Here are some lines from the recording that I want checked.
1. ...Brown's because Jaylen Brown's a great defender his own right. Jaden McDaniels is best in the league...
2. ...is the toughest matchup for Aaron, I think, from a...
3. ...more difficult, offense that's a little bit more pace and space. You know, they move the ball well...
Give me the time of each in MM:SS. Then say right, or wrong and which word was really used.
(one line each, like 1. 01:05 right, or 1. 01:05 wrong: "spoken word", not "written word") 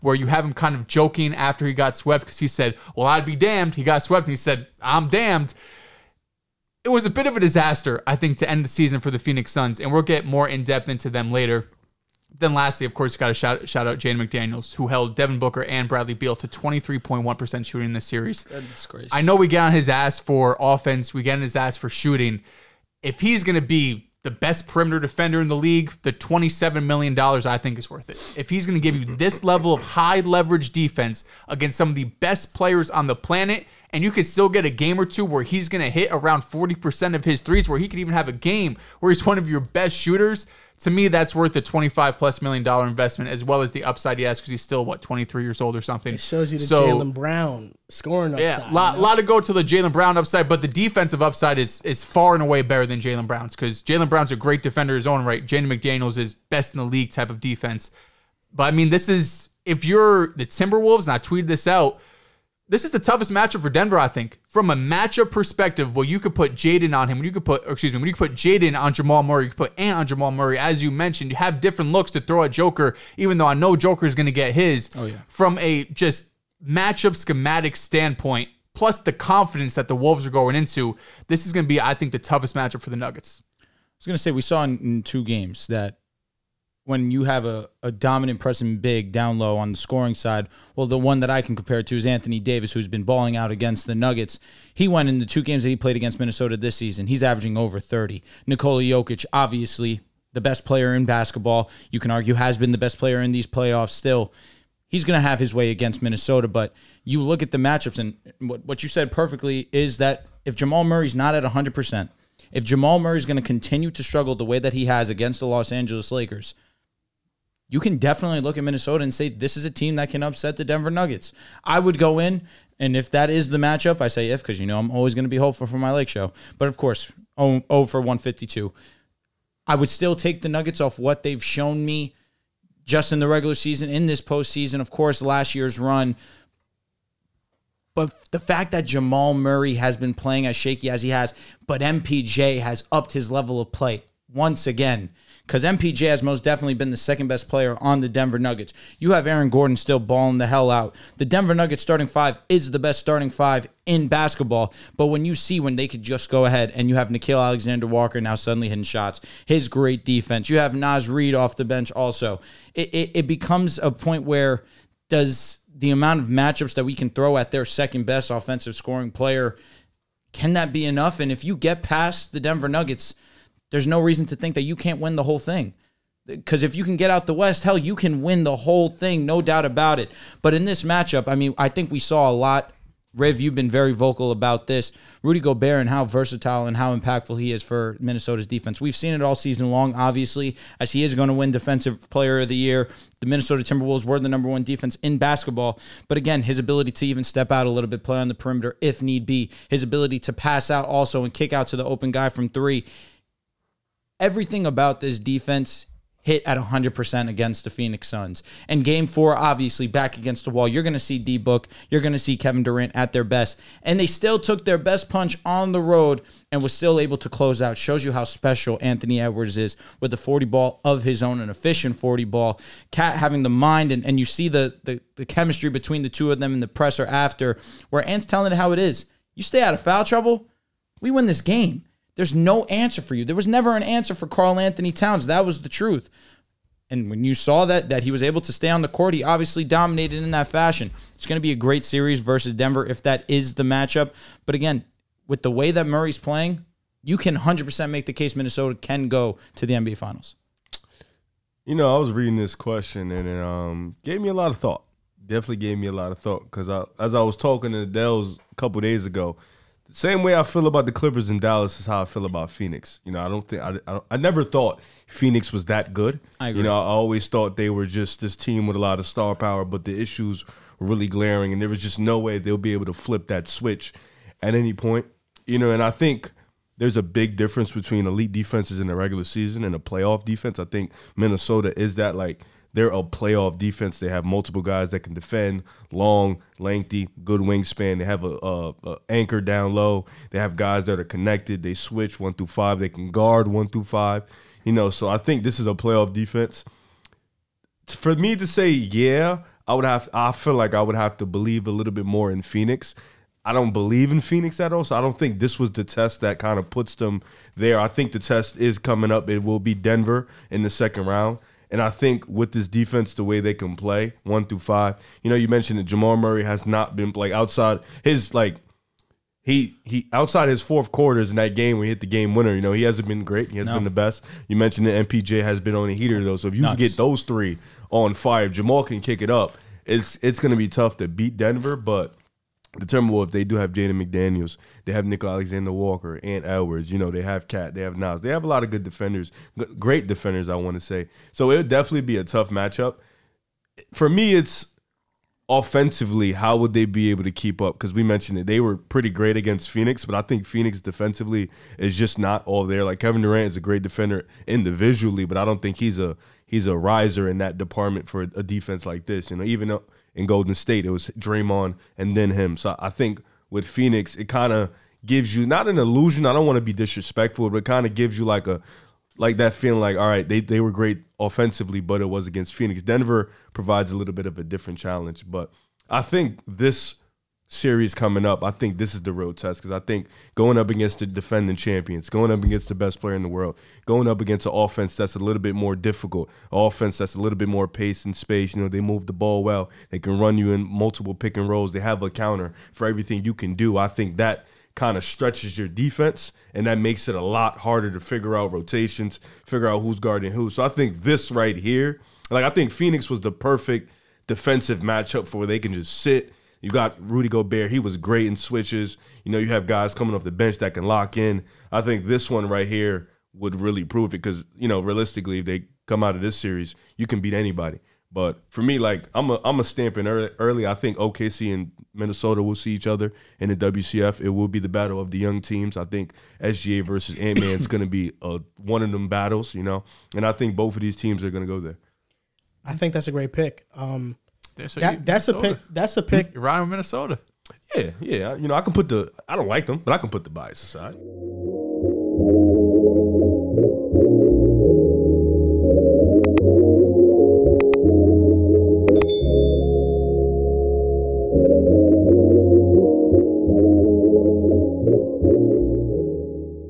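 1. 00:53 right
2. 01:02 wrong: "Denver", not "Aaron"
3. 06:25 right.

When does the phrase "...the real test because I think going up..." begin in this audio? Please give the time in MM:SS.
06:19.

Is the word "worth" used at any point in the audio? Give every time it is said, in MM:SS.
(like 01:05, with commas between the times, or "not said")
00:27, 00:41.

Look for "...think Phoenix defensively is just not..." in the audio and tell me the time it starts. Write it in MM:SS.
05:50.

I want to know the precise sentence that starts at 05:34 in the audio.
They have Nico Alexander Walker and Edwards.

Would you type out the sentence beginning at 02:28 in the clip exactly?
You have Aaron Gordon still balling the hell out.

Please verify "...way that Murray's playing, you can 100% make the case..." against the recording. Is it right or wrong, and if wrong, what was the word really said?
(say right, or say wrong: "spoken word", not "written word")
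right.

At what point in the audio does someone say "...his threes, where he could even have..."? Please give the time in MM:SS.
00:37.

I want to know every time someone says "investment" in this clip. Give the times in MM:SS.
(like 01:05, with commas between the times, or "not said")
00:42.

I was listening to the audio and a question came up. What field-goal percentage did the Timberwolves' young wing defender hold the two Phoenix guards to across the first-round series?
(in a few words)
23.1%.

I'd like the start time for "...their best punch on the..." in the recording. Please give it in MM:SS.
03:34.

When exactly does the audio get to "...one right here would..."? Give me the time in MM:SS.
06:52.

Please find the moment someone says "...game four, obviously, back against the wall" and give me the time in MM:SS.
03:28.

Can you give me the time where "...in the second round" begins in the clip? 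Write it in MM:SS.
05:10.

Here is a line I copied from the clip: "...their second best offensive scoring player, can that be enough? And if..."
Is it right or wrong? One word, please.
right.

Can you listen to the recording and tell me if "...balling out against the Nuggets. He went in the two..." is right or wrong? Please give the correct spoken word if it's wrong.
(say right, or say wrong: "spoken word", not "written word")
right.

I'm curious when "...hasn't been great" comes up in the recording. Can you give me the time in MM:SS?
05:22.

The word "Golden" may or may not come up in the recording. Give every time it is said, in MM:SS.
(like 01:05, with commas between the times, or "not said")
06:00.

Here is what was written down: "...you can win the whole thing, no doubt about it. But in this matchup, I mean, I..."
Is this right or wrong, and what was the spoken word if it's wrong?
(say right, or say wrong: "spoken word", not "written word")
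right.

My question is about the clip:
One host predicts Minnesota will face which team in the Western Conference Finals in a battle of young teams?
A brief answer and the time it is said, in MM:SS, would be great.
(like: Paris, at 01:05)
OKC, at 07:00.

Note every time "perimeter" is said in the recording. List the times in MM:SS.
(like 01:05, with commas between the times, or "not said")
00:24, 03:18.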